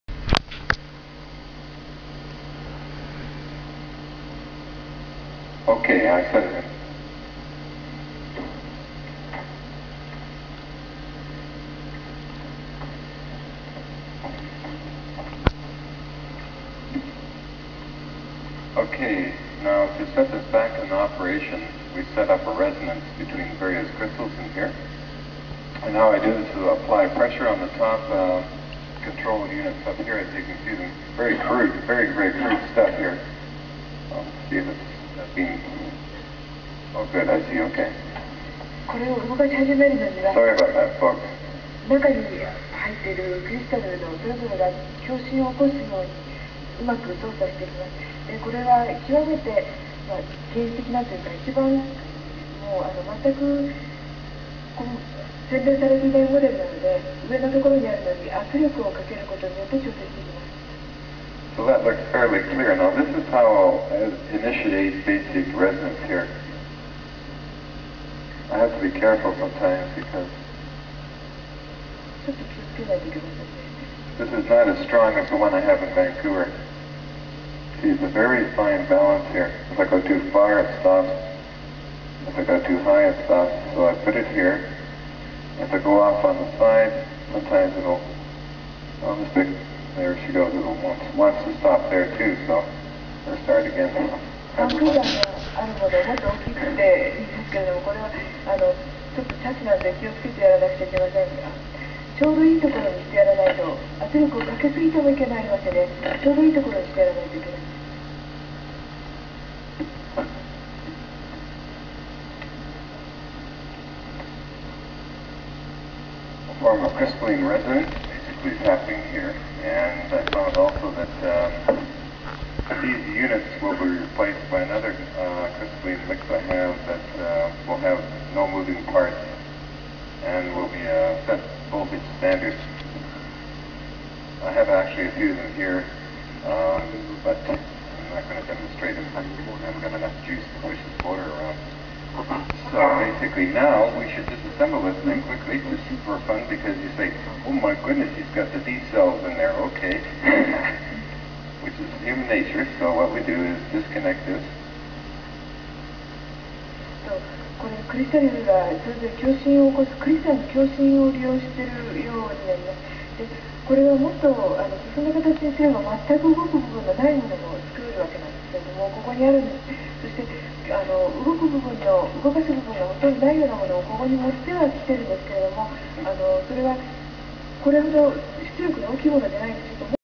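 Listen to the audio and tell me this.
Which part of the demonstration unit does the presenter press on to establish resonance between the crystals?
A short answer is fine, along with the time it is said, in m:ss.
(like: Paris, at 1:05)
control units, at 0:29.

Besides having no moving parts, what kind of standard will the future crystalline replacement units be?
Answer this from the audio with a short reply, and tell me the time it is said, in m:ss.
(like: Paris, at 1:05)
set voltage standard, at 2:11.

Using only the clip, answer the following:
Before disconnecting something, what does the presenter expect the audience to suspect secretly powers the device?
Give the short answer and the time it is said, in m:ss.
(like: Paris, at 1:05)
D cells, at 2:28.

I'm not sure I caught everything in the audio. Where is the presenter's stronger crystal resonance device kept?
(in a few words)
Vancouver.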